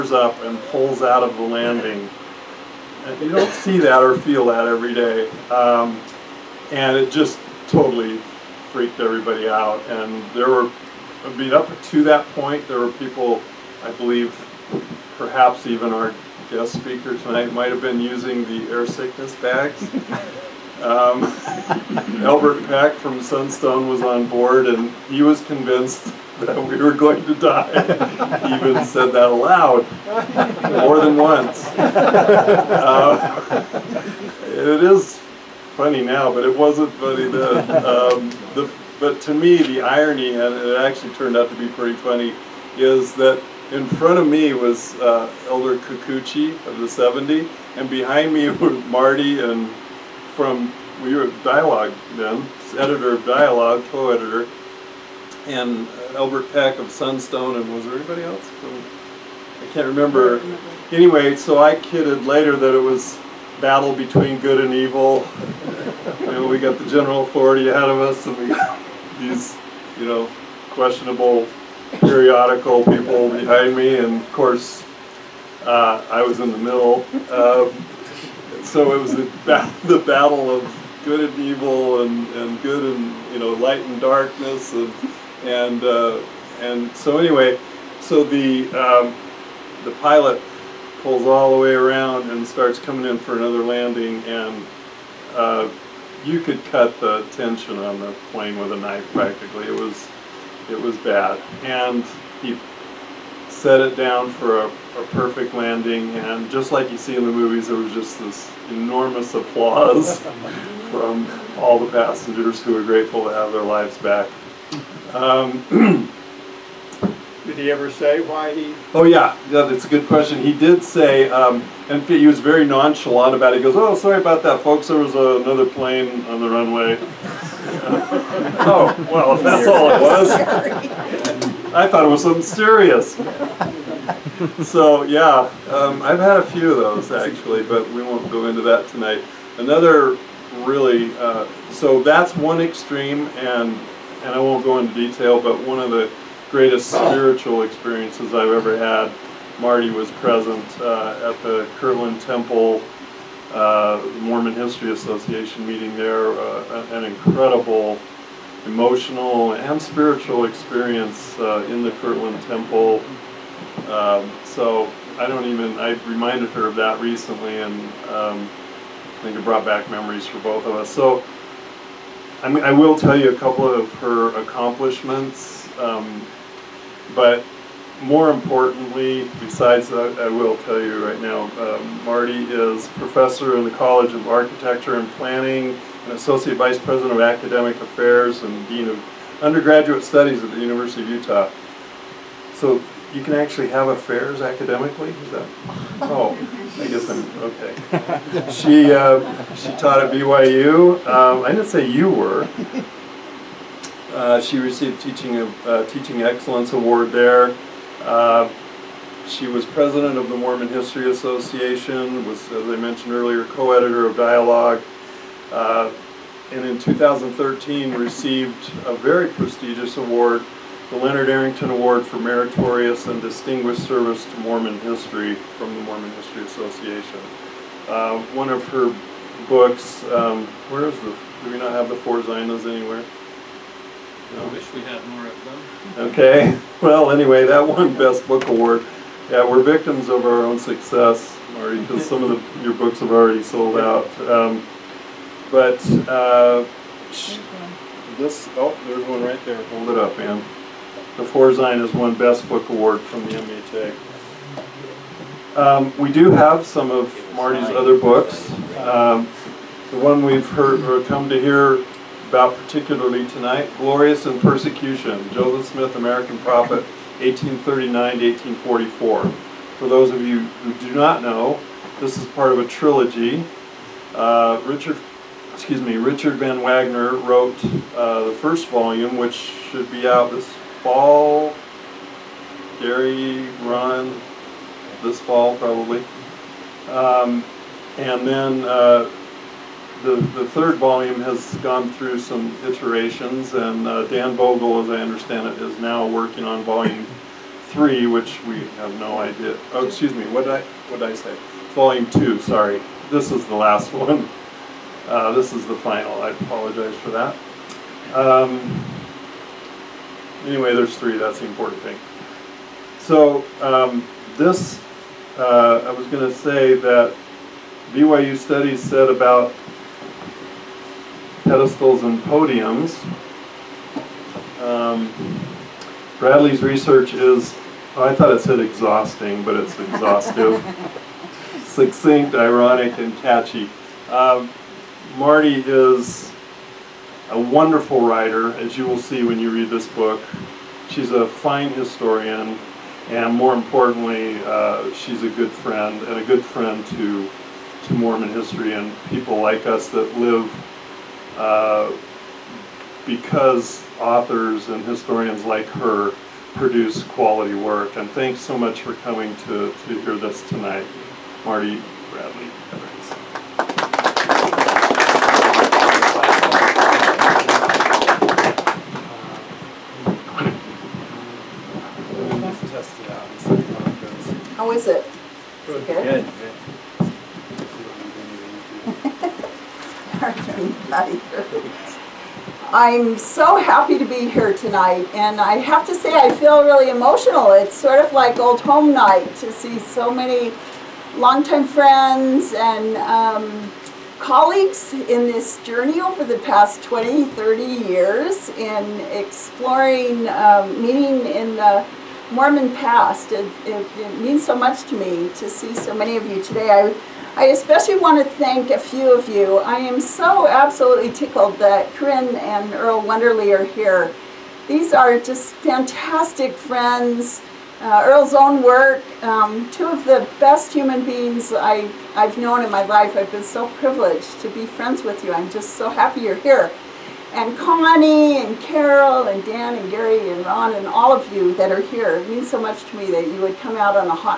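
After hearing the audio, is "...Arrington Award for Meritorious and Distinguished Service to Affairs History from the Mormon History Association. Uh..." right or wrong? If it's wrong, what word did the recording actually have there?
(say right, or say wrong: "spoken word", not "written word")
wrong: "Mormon", not "Affairs".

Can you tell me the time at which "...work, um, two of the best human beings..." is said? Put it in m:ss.
6:58.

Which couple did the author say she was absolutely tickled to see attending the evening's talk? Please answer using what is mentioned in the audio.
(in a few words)
Corinne and Earl Wunderli.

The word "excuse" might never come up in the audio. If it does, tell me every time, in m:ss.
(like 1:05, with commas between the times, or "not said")
4:35, 4:59.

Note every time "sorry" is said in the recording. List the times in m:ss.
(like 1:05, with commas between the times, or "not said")
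2:03, 5:02.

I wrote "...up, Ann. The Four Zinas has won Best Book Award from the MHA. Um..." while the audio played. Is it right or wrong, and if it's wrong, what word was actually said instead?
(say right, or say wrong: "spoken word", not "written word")
right.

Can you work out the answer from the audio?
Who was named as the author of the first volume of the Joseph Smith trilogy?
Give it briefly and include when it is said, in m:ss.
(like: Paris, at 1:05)
Richard Van Wagoner, at 4:35.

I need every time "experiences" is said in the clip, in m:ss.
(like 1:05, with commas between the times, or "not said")
2:27, 2:40.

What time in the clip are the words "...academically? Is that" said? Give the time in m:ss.
3:14.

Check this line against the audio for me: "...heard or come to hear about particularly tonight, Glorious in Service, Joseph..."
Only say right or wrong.
wrong.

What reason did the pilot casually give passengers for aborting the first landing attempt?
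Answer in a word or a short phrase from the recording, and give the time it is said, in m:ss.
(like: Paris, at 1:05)
another plane on the runway, at 2:05.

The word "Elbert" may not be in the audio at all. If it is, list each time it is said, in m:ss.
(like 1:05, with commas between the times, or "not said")
0:22, 0:56.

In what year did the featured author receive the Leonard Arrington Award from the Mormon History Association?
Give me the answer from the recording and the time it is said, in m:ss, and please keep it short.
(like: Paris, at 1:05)
2013, at 3:36.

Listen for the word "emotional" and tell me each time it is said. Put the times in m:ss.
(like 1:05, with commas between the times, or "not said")
2:38, 6:26.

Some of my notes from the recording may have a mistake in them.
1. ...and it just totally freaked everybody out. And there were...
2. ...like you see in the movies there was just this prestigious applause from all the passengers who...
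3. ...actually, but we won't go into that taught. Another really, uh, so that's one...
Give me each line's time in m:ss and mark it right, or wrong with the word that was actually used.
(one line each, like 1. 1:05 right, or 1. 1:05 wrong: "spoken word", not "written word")
1. 0:06 right
2. 1:46 wrong: "enormous", not "prestigious"
3. 2:17 wrong: "tonight", not "taught".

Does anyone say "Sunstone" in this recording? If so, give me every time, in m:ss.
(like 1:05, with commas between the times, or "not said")
0:23, 0:56.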